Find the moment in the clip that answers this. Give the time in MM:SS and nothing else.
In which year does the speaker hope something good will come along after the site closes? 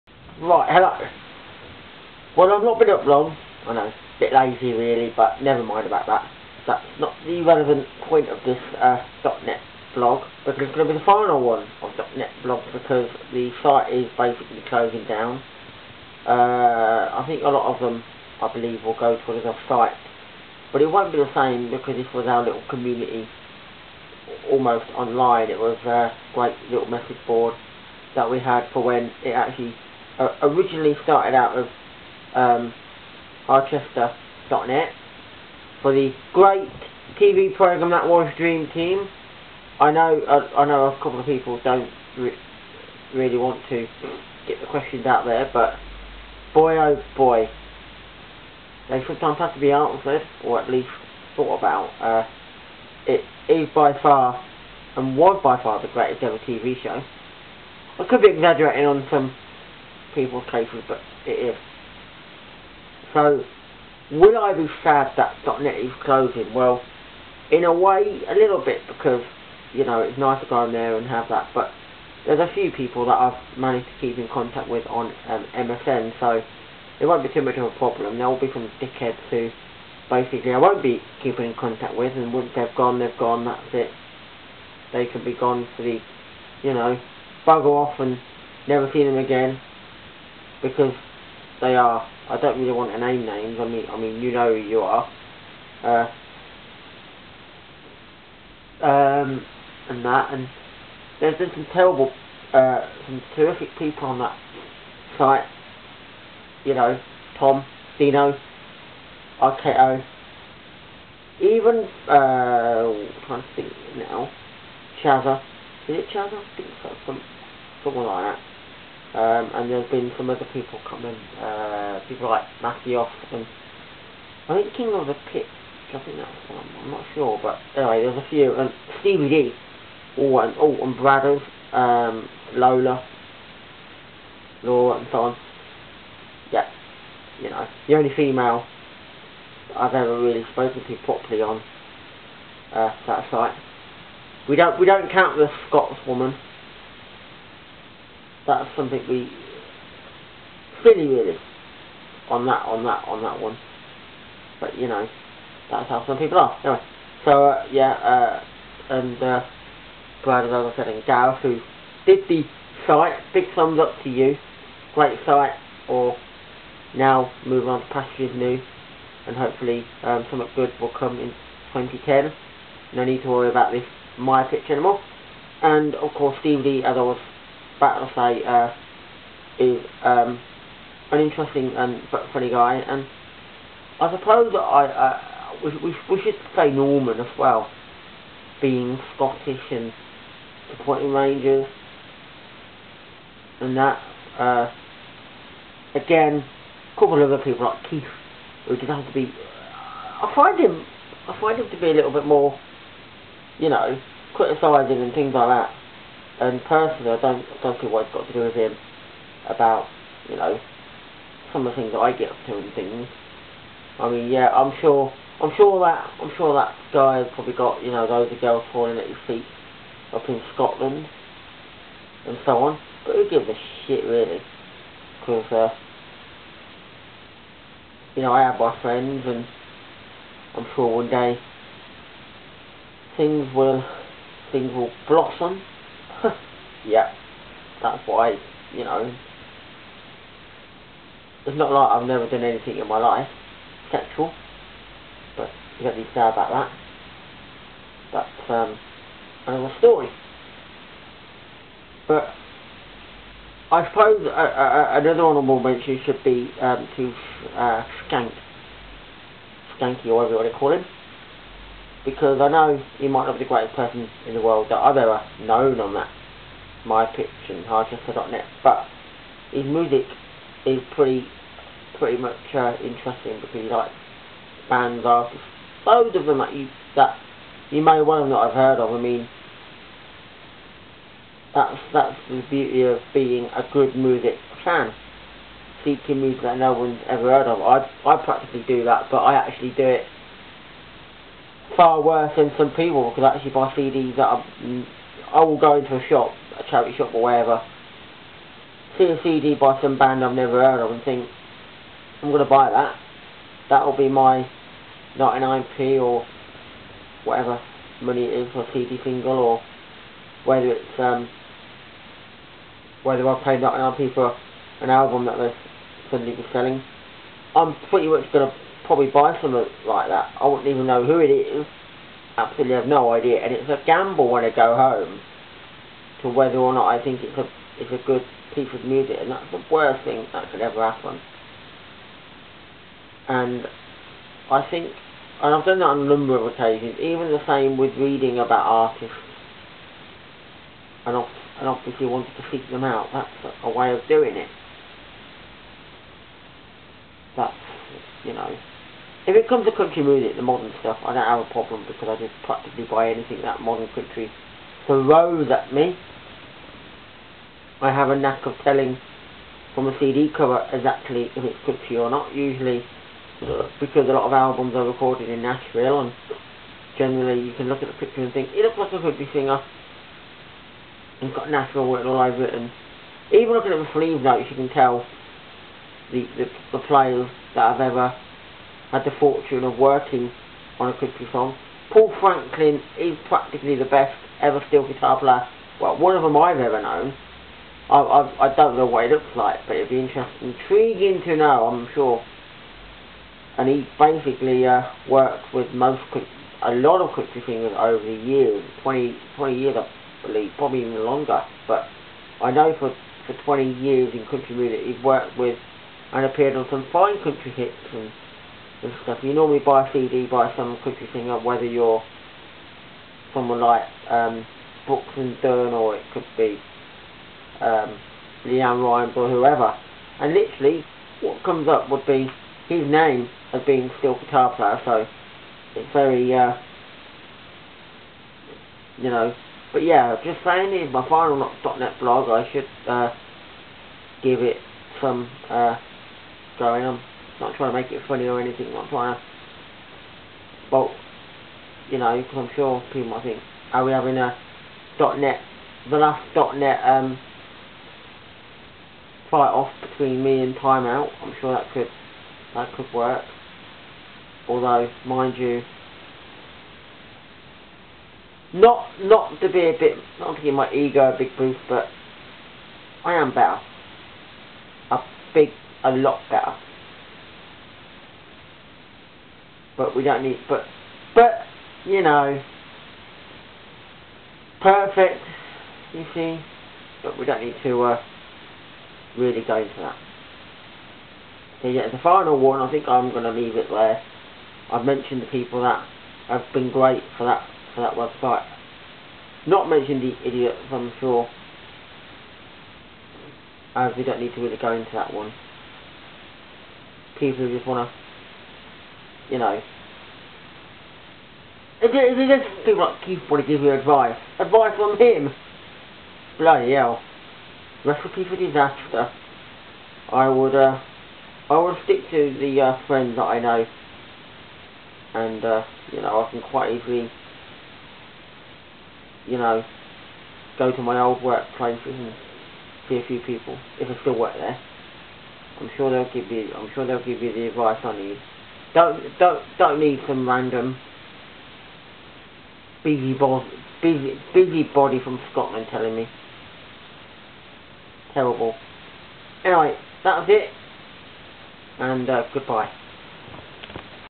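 02:51.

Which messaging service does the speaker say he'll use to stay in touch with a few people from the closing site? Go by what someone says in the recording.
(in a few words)
MSN.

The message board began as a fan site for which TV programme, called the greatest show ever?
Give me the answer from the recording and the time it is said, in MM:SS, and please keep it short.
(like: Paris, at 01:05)
Dream Team, at 00:38.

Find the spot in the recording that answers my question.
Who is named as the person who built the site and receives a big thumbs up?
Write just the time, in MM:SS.
02:41.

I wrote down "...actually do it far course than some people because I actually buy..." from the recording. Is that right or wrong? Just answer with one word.
wrong.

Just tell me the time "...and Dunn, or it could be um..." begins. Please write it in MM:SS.
06:55.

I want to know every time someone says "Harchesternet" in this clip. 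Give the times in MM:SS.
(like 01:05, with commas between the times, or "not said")
00:33, 04:27.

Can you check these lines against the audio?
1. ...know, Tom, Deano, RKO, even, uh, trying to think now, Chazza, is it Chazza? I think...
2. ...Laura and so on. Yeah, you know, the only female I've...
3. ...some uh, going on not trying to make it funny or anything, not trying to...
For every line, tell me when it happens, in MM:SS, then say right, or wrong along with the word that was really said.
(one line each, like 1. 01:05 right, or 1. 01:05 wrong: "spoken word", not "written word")
1. 01:46 right
2. 02:14 right
3. 07:14 right.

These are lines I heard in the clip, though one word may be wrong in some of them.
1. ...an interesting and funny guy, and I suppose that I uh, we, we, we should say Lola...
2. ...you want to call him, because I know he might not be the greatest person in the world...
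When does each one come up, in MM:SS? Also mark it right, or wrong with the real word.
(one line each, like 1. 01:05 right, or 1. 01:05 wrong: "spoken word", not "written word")
1. 03:01 wrong: "Norman", not "Lola"
2. 04:20 right.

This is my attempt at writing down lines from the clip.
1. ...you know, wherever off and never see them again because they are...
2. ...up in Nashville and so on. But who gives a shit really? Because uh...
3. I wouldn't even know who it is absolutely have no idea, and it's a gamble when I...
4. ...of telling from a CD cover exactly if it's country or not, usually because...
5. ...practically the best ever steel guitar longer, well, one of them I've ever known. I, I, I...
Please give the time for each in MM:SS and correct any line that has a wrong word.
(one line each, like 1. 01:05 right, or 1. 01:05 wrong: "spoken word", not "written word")
1. 01:26 wrong: "bugger", not "wherever"
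2. 03:40 wrong: "Scotland", not "Nashville"
3. 05:20 right
4. 05:58 right
5. 06:23 wrong: "player", not "longer".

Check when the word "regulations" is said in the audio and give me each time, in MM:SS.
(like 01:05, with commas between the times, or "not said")
not said.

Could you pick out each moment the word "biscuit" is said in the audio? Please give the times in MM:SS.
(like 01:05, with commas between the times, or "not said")
not said.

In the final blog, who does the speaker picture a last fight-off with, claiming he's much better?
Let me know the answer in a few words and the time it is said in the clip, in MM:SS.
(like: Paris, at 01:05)
Timeout, at 07:30.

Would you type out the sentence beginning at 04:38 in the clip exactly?
I mean, that's that's the beauty of being a good music fan.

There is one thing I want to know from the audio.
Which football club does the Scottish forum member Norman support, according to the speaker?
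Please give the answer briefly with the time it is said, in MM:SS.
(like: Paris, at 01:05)
Rangers, at 03:11.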